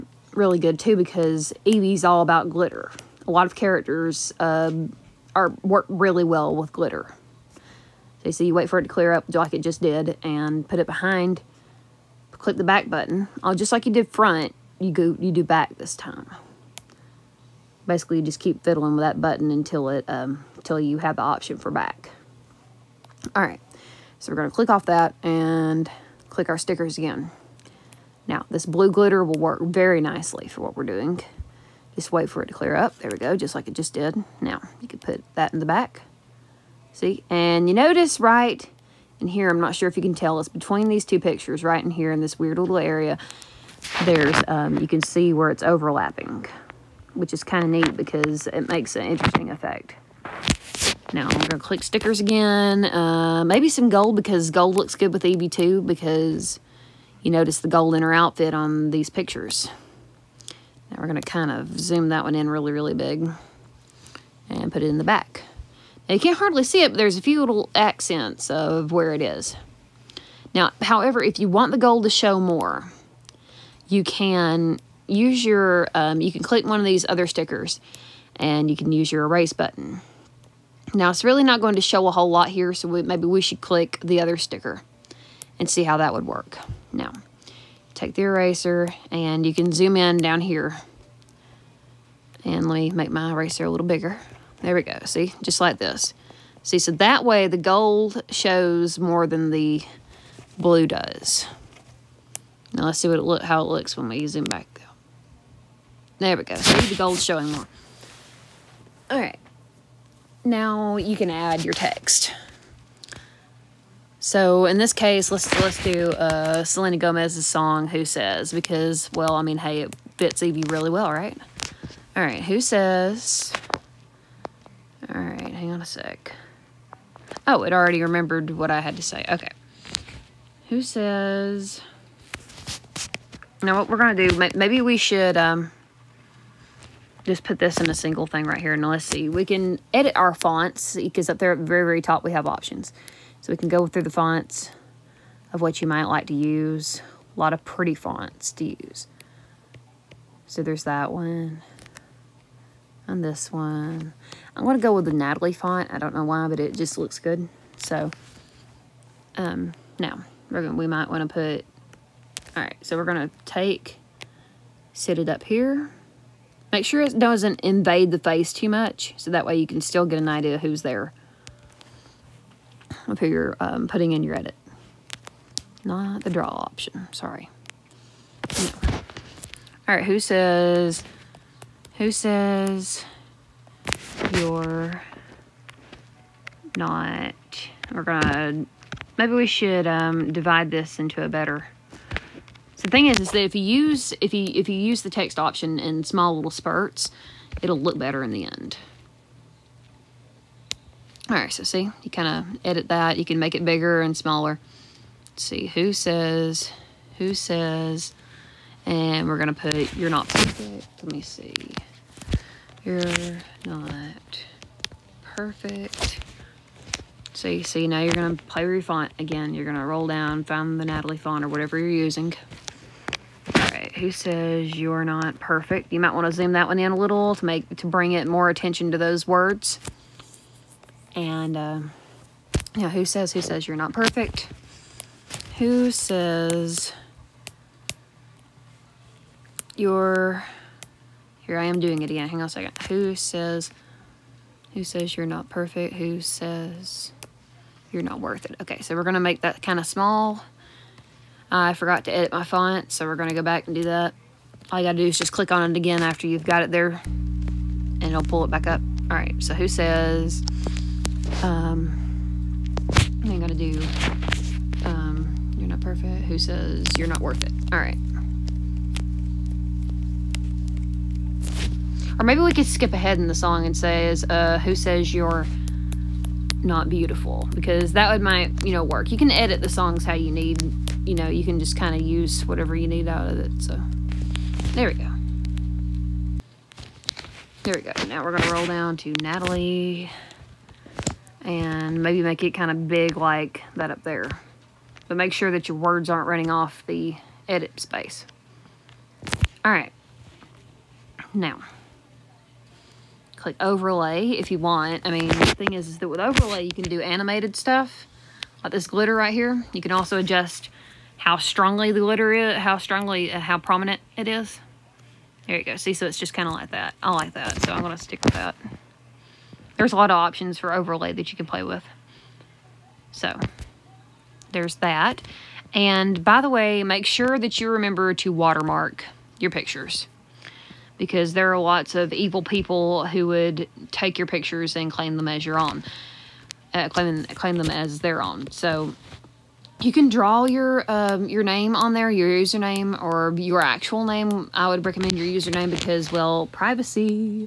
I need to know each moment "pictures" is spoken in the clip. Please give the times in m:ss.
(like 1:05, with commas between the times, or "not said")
0:41, 0:59, 5:29, 5:34.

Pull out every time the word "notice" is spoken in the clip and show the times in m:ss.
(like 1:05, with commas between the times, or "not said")
0:37, 0:57.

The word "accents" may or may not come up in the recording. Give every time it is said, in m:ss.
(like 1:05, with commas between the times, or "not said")
1:07.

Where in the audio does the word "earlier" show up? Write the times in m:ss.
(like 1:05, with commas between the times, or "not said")
not said.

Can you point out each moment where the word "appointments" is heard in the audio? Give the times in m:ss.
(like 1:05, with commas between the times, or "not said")
not said.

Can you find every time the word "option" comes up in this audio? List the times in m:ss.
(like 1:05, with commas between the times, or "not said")
0:21, 2:22, 2:56, 3:15, 5:20.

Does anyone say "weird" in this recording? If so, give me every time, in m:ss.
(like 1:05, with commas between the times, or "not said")
0:42.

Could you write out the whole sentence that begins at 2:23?
So we can go through the fonts of what you might like to use.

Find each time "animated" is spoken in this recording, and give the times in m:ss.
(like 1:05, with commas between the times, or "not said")
5:07.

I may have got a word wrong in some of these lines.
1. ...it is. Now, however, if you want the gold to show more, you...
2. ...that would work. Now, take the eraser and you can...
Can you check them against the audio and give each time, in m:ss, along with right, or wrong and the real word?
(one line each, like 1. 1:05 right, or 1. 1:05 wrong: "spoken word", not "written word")
1. 1:09 right
2. 1:25 right.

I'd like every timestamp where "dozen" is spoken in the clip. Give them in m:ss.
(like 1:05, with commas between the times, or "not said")
not said.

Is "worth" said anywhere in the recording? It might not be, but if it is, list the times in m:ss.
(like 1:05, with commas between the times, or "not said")
4:08, 4:27.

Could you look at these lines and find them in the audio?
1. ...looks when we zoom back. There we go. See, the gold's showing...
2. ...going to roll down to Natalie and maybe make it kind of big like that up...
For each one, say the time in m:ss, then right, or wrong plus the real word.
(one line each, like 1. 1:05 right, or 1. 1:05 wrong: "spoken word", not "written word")
1. 1:43 right
2. 4:48 right.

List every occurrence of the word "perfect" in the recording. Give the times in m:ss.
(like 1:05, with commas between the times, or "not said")
3:30, 3:35, 3:45, 3:53, 4:05, 4:25.